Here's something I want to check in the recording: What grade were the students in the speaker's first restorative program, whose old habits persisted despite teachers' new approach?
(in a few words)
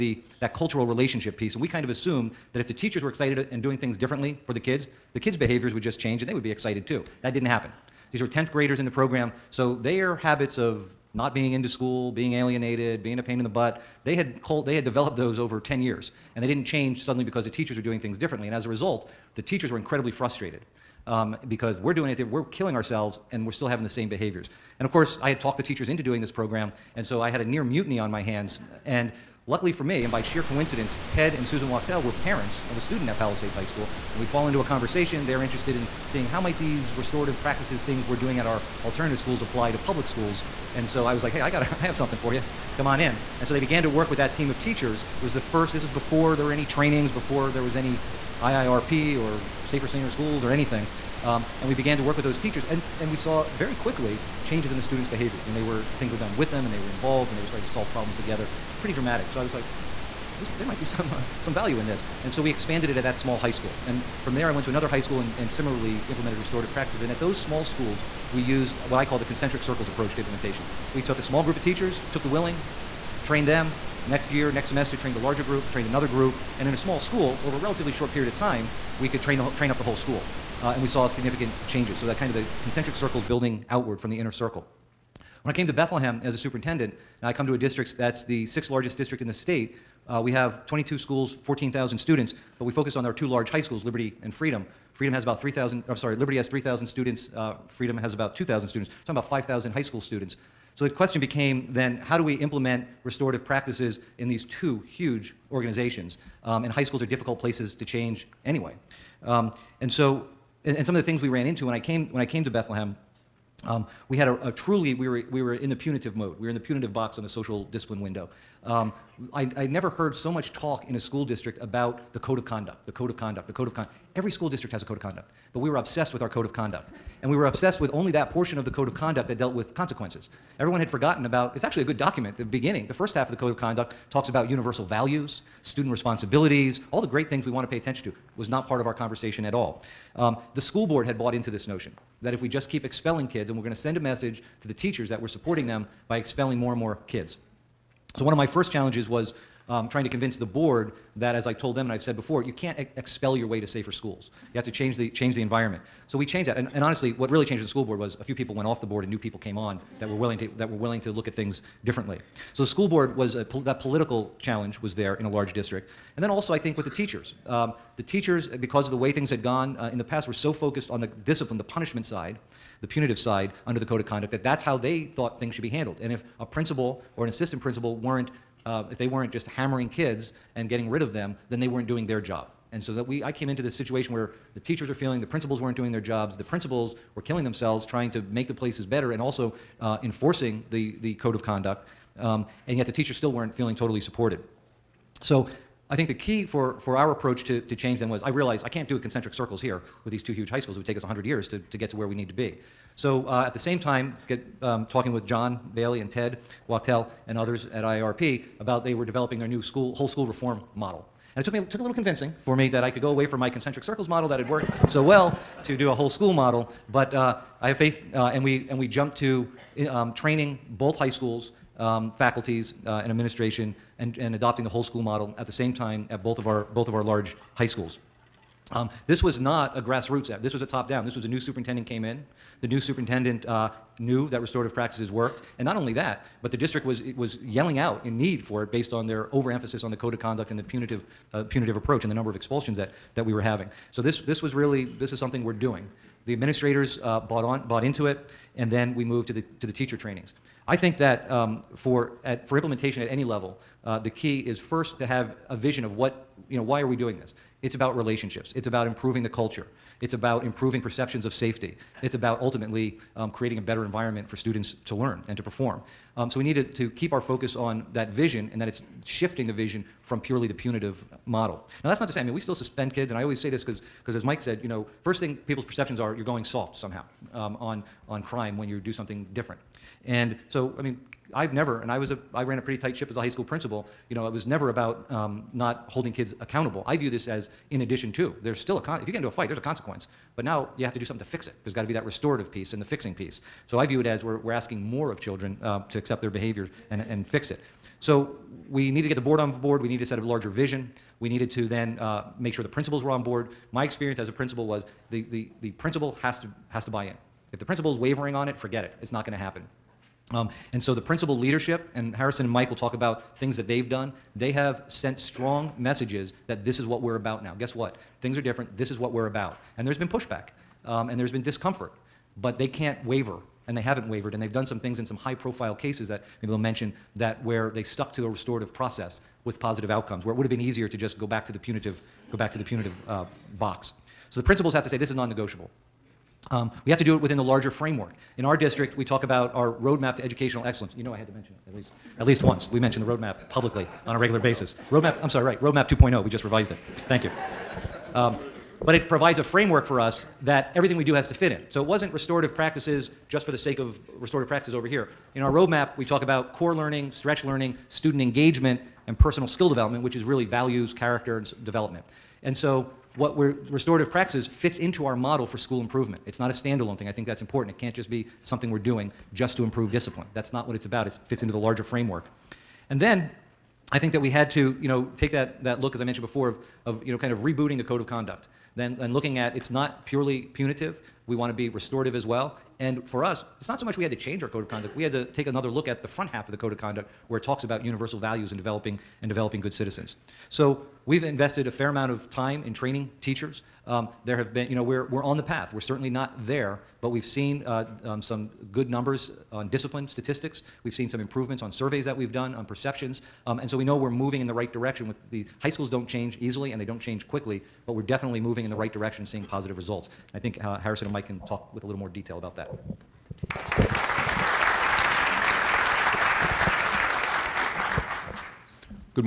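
10th graders.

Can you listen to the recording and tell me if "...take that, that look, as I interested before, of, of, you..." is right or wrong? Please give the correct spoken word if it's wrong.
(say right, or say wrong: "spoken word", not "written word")
wrong: "mentioned", not "interested".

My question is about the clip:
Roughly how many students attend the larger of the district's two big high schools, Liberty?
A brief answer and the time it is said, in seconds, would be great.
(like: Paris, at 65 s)
3,000, at 96 s.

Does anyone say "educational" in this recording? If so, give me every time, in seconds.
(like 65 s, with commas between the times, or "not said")
340 s.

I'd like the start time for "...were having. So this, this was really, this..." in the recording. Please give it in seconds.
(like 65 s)
243 s.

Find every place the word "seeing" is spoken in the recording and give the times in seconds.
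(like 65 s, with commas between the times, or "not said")
36 s, 409 s.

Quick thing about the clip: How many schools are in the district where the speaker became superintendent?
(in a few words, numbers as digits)
22.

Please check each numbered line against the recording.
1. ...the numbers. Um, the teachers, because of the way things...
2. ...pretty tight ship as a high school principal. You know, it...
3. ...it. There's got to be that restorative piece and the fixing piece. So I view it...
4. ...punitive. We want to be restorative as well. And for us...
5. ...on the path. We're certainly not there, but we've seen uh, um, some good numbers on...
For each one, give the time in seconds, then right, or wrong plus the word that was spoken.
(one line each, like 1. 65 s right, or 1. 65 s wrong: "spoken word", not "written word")
1. 166 s wrong: "teachers", not "numbers"
2. 282 s right
3. 291 s right
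4. 380 s right
5. 395 s right.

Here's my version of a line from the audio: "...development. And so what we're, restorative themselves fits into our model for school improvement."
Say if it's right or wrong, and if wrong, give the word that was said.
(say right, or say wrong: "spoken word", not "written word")
wrong: "practices", not "themselves".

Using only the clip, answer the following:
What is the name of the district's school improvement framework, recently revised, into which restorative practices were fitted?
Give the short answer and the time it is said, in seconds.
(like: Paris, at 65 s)
Roadmap 2.0, at 345 s.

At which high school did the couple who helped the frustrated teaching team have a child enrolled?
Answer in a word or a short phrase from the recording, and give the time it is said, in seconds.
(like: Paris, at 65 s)
Palisades High School, at 33 s.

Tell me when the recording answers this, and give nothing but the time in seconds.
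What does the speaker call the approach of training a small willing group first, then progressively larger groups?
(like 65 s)
69 s.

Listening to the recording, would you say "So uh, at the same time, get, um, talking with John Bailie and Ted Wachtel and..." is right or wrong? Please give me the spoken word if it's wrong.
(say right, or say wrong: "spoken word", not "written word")
right.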